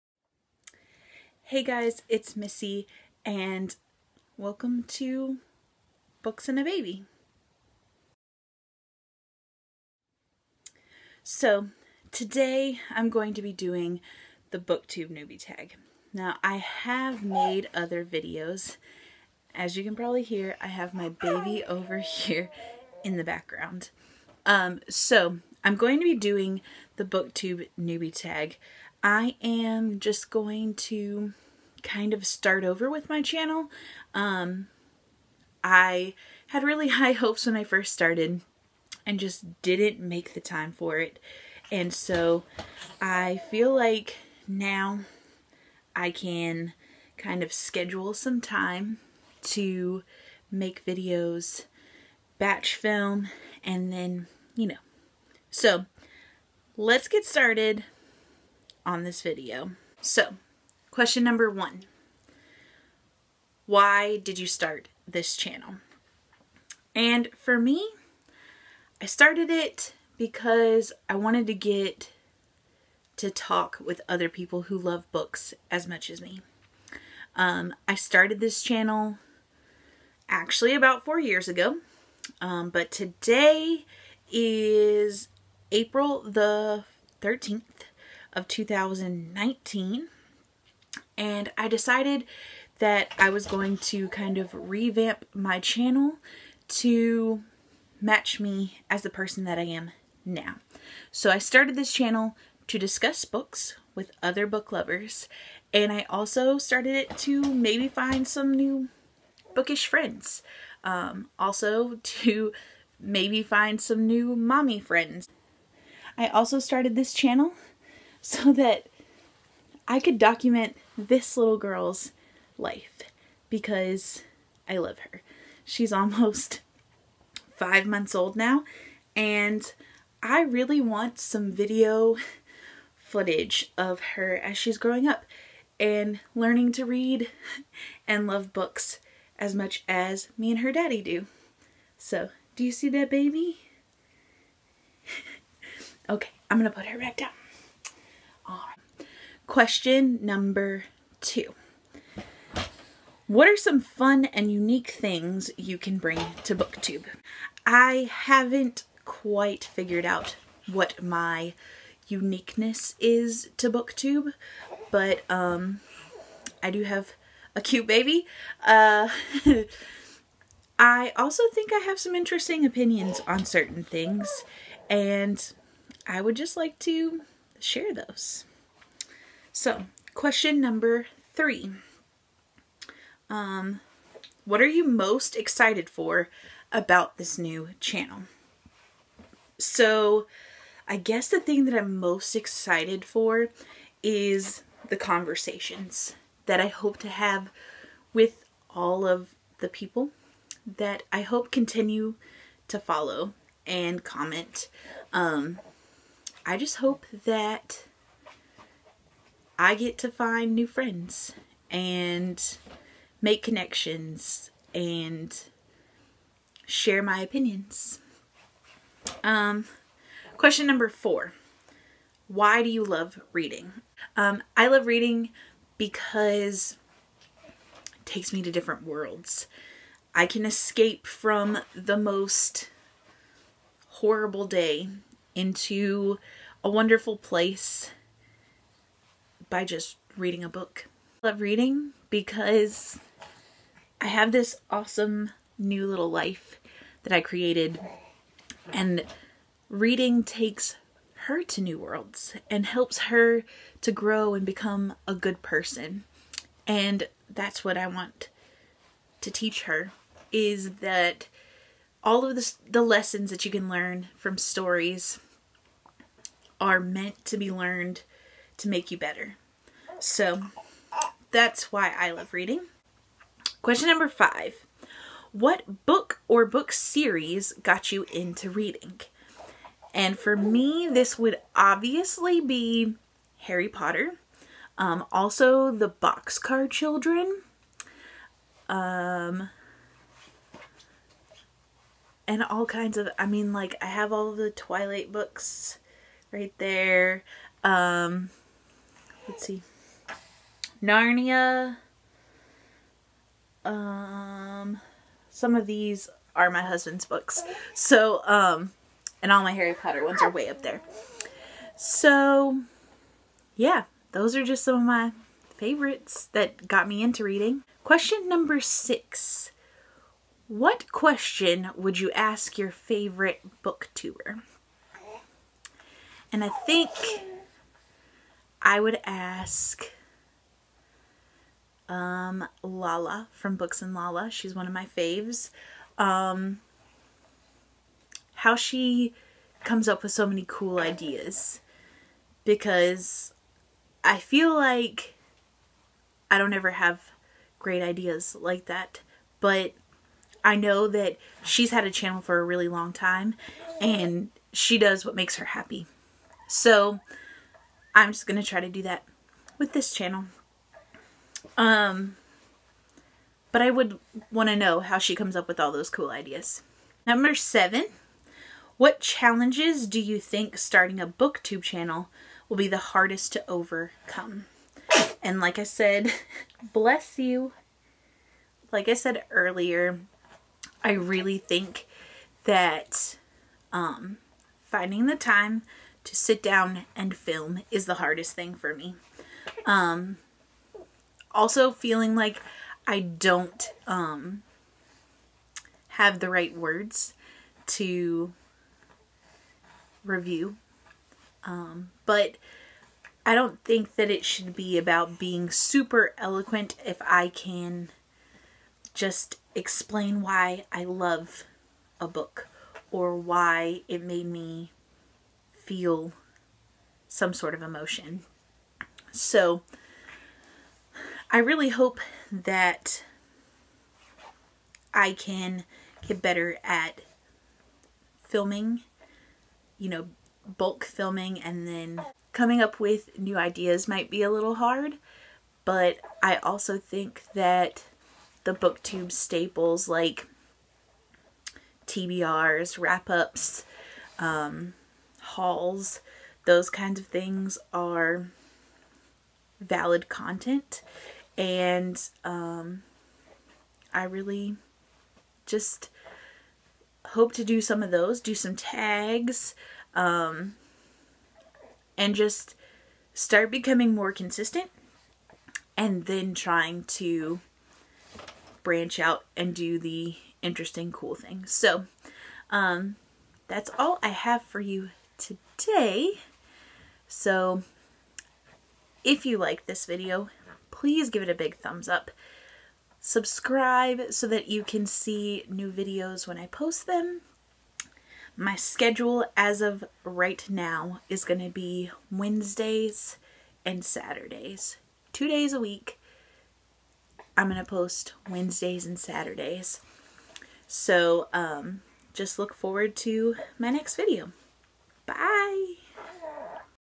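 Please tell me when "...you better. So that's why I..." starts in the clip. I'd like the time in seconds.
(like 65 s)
268 s.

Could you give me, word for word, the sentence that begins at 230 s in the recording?
I can escape from the most horrible day into a wonderful place by just reading a book.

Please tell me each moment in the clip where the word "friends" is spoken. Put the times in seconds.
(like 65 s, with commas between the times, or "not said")
109 s, 114 s, 210 s.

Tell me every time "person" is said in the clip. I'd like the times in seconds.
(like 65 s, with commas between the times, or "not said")
99 s, 255 s.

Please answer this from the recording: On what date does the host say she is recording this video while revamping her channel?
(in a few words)
April 13, 2019.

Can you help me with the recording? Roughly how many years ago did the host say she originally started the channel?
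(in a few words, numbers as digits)
4.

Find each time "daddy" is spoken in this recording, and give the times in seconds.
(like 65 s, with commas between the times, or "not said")
140 s.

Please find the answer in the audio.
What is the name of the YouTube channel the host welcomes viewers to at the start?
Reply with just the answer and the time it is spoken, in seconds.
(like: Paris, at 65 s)
Books and a Baby, at 6 s.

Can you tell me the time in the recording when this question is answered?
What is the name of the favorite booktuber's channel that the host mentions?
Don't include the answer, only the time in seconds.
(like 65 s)
333 s.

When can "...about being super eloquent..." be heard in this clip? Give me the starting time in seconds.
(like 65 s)
404 s.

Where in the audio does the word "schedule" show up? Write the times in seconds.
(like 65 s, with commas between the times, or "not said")
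47 s, 488 s.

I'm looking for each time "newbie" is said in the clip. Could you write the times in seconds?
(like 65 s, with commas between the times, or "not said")
15 s, 27 s.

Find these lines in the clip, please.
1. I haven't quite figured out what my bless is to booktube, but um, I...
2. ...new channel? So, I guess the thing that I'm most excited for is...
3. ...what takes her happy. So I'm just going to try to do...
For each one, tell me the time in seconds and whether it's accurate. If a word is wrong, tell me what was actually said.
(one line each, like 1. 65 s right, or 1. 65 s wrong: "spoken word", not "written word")
1. 157 s wrong: "uniqueness", not "bless"
2. 187 s right
3. 355 s wrong: "makes", not "takes".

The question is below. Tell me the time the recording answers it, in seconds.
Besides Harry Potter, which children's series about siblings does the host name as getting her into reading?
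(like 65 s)
285 s.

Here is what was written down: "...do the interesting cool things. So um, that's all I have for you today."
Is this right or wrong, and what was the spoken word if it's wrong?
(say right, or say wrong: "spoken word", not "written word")
right.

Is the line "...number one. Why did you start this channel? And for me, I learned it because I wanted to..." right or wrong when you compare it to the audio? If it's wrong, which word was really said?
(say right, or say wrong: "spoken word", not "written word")
wrong: "started", not "learned".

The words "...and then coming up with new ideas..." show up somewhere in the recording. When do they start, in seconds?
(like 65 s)
431 s.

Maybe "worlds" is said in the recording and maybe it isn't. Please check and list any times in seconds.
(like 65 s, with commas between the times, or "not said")
228 s, 251 s.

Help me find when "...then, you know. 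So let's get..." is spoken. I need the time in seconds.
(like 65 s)
53 s.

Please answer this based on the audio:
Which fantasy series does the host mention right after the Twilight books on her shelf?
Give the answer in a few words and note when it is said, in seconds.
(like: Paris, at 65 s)
Narnia, at 300 s.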